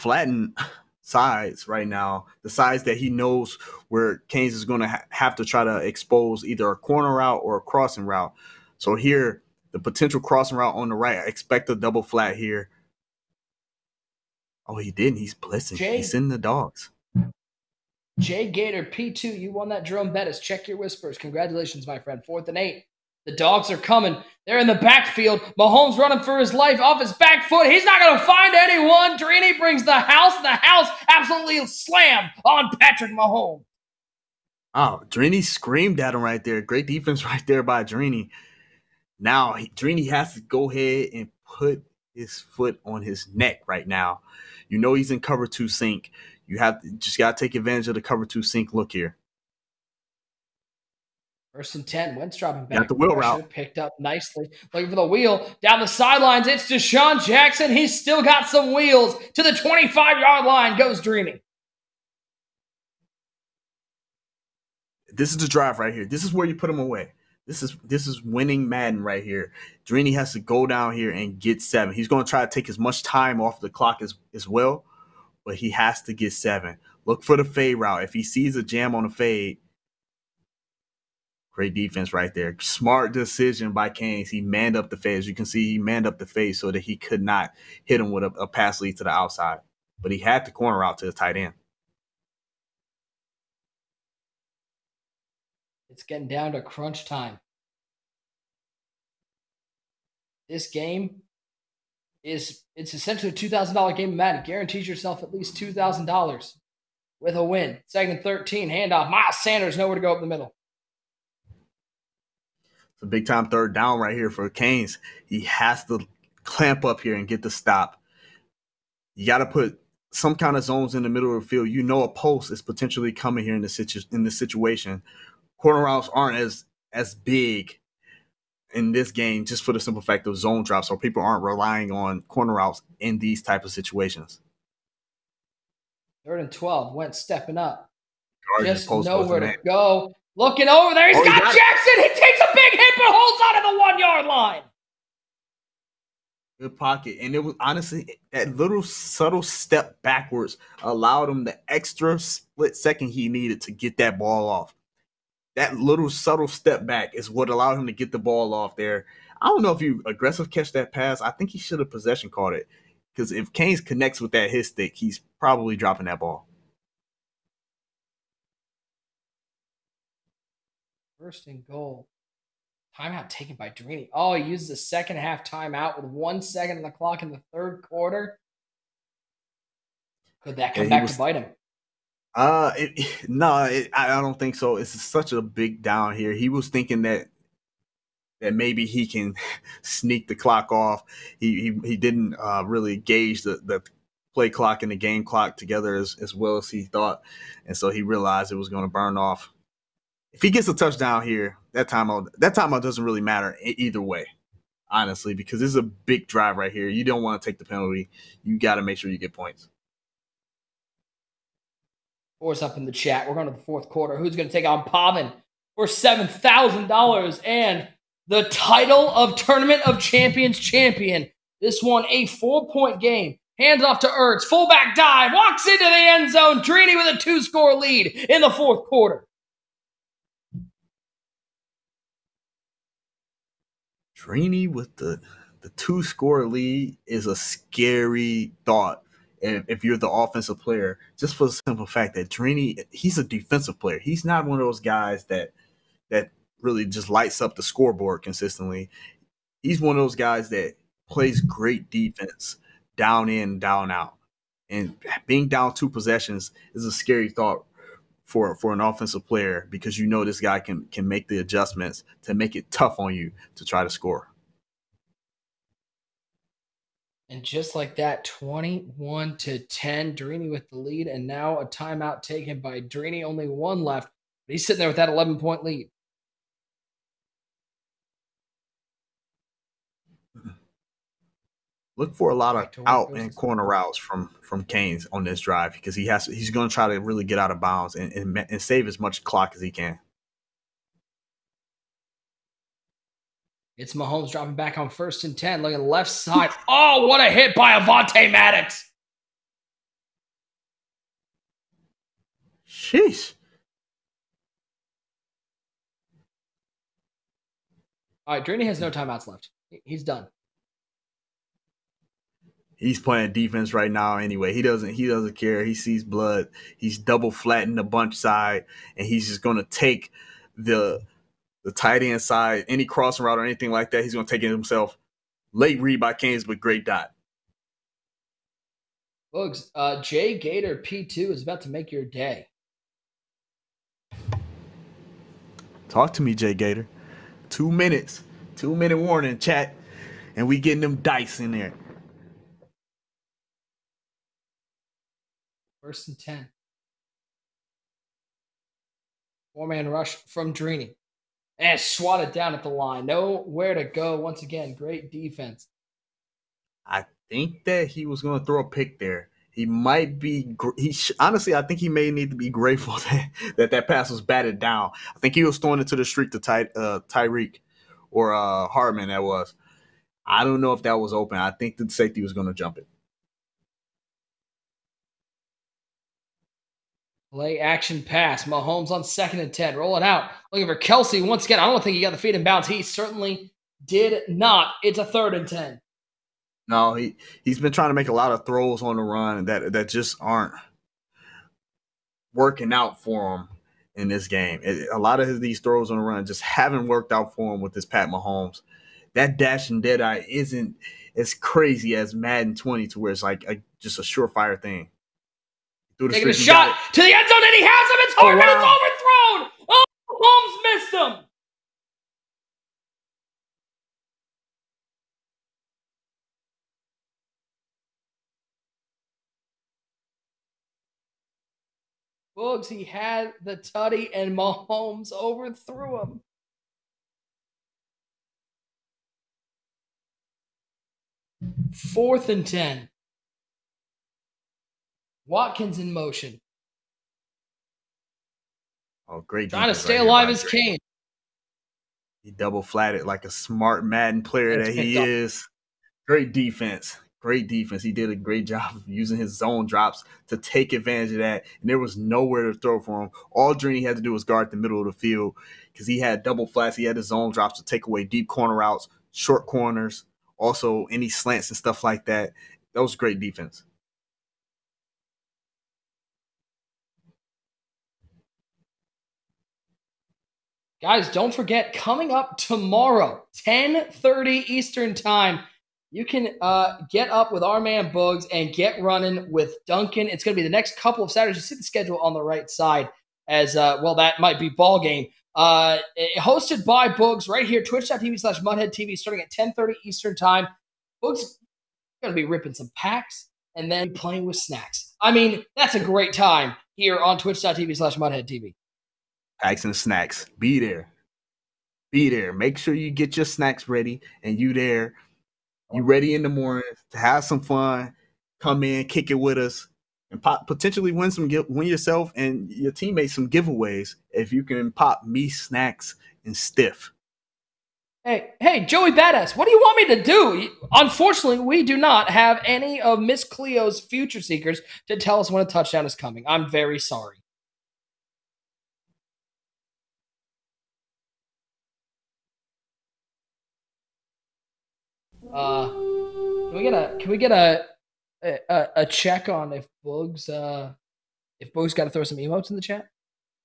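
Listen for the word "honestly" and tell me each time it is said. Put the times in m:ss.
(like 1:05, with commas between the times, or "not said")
2:27, 3:24, 6:01.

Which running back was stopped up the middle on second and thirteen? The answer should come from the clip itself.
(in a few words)
Miles Sanders.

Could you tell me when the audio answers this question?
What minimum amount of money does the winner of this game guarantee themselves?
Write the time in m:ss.
1:45.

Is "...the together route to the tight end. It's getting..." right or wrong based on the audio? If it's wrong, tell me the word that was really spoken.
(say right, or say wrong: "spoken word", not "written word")
wrong: "corner", not "together".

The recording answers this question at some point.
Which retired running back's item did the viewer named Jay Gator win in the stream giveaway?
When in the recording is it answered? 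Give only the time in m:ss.
0:19.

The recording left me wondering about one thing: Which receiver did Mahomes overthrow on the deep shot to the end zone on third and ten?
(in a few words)
Hardman.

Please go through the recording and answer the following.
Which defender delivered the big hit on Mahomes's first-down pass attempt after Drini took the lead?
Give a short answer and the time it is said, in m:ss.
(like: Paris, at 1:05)
Avonte Maddox, at 4:57.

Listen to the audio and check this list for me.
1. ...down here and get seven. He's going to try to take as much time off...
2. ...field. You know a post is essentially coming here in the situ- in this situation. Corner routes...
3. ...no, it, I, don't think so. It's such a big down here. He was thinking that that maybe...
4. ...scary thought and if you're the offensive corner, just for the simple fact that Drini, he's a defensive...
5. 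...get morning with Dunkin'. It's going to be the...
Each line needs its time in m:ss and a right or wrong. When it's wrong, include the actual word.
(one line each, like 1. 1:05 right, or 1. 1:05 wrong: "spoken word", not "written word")
1. 1:10 right
2. 2:01 wrong: "potentially", not "essentially"
3. 3:03 right
4. 3:57 wrong: "player", not "corner"
5. 7:58 wrong: "running", not "morning".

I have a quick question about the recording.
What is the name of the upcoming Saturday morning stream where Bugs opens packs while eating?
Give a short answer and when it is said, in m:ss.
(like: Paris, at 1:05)
Packs and snacks, at 8:19.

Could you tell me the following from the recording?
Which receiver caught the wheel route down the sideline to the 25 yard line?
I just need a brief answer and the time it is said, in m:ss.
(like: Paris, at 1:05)
DeSean Jackson, at 0:56.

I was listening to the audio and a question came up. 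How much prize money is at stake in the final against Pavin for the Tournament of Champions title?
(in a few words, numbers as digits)
$7,000.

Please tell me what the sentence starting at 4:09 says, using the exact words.
He's one of those guys that plays great defense down in, down out.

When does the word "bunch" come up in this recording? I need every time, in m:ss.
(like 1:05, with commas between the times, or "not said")
5:17.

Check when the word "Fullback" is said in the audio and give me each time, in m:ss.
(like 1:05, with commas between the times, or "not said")
3:44.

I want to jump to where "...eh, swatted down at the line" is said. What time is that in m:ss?
5:51.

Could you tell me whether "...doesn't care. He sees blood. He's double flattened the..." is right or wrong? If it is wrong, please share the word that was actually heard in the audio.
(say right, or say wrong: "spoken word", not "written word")
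right.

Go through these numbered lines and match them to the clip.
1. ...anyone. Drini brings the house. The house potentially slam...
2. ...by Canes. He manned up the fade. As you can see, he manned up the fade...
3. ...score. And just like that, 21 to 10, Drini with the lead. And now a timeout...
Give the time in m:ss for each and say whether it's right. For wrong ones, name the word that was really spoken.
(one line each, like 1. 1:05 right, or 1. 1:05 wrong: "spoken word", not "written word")
1. 0:28 wrong: "absolutely", not "potentially"
2. 1:23 right
3. 4:23 right.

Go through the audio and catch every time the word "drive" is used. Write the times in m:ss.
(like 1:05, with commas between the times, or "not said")
1:05, 3:26, 4:45.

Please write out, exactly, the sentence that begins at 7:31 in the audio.
And there was nowhere to throw for him.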